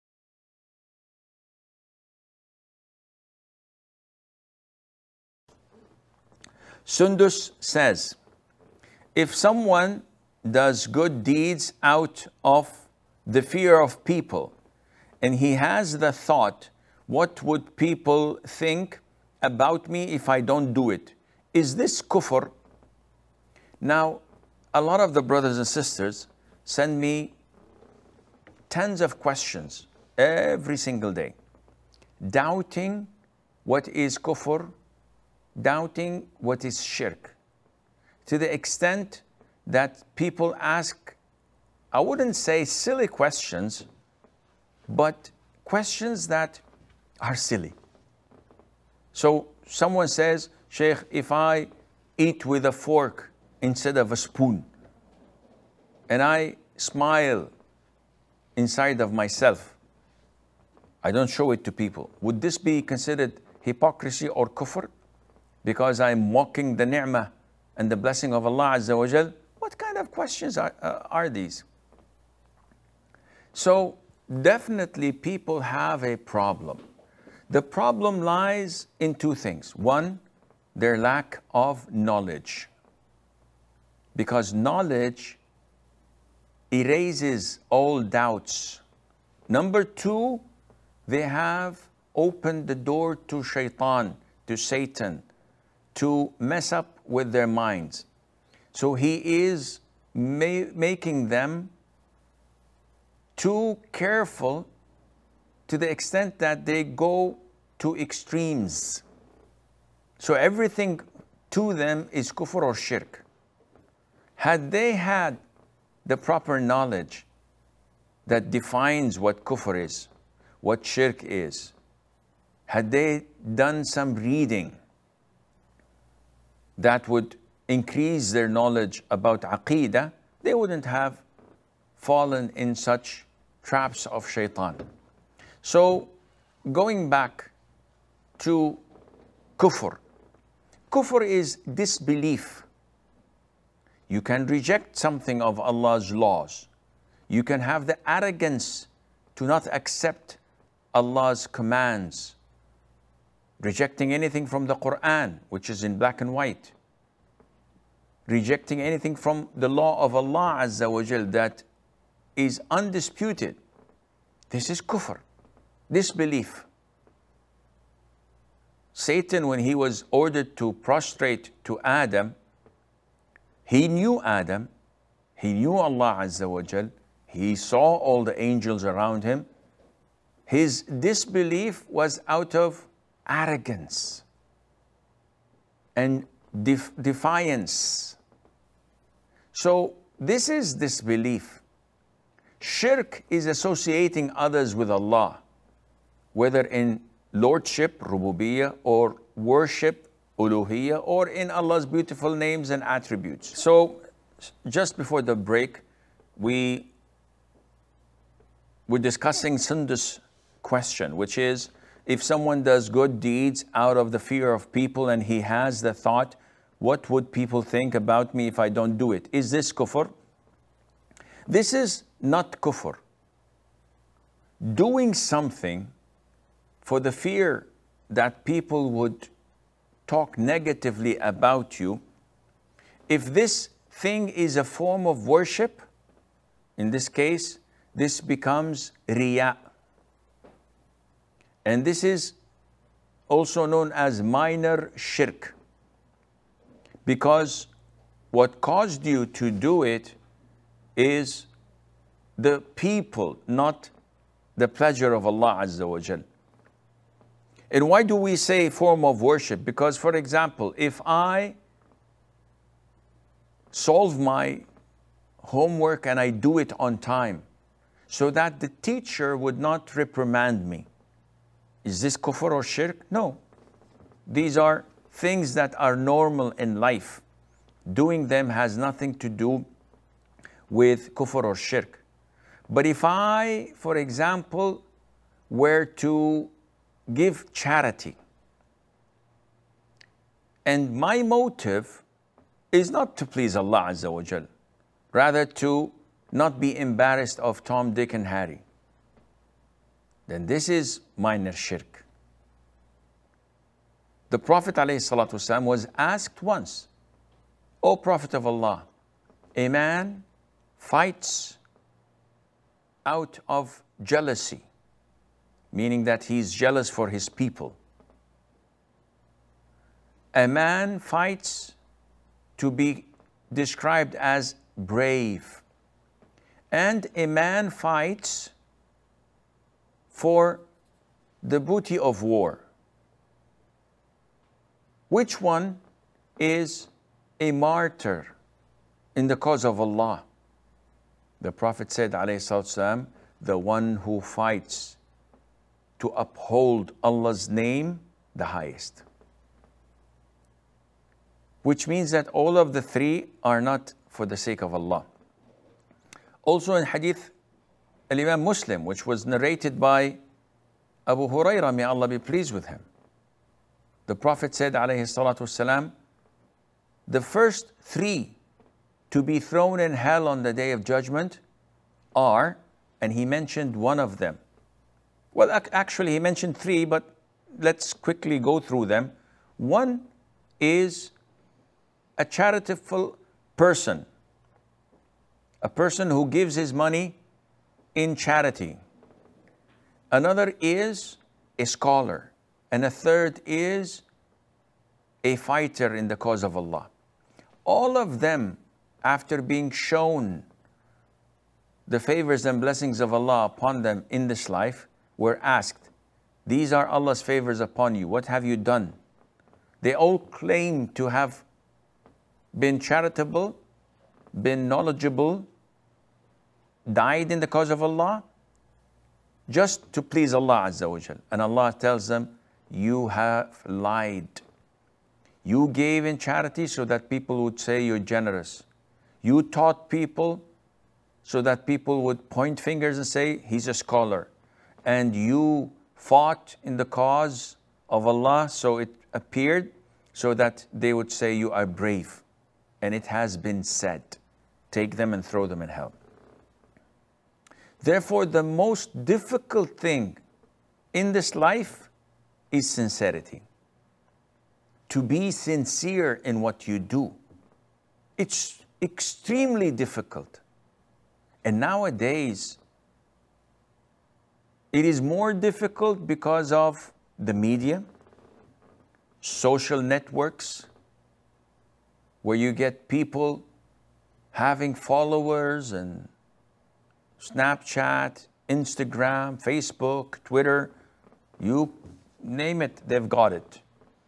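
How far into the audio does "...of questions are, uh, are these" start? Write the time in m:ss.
1:09.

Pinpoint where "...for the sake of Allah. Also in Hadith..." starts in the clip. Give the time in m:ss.
5:54.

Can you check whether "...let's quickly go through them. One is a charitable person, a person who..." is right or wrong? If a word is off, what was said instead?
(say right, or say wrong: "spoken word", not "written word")
right.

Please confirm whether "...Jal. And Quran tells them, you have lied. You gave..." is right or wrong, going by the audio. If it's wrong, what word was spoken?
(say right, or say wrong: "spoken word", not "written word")
wrong: "Allah", not "Quran".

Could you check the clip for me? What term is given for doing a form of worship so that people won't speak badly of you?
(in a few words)
Riya.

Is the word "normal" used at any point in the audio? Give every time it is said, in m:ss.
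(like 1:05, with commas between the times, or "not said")
4:35.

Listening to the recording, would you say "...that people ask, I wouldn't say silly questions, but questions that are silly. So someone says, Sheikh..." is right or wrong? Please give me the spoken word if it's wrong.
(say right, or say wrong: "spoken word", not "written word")
right.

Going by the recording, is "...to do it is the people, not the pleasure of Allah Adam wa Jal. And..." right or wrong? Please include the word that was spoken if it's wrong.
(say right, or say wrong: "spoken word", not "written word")
wrong: "Azza", not "Adam".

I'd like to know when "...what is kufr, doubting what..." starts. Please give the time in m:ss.
0:33.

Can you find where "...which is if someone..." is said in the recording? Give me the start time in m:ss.
3:31.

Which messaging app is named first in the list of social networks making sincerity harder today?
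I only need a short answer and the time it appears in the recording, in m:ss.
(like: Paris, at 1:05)
Snapchat, at 7:57.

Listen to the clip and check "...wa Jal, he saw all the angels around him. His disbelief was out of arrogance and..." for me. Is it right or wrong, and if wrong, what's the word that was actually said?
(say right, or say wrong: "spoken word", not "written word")
right.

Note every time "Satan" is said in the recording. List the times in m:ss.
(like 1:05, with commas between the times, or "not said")
1:34, 2:48.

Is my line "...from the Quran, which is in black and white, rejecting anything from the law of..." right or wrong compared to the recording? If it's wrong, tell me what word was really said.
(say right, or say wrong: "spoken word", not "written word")
right.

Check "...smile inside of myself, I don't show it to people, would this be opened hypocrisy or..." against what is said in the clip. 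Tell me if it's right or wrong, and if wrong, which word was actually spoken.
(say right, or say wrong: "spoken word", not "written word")
wrong: "considered", not "opened".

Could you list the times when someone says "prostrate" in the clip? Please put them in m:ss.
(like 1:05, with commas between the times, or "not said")
2:50.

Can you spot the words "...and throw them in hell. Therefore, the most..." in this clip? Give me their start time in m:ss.
7:25.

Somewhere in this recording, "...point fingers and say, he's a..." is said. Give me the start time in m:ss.
7:12.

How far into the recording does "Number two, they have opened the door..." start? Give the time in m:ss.
1:29.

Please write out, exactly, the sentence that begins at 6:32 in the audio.
And a third is a fighter in the cause of Allah.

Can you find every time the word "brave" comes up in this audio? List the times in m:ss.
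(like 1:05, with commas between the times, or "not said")
5:24, 7:21.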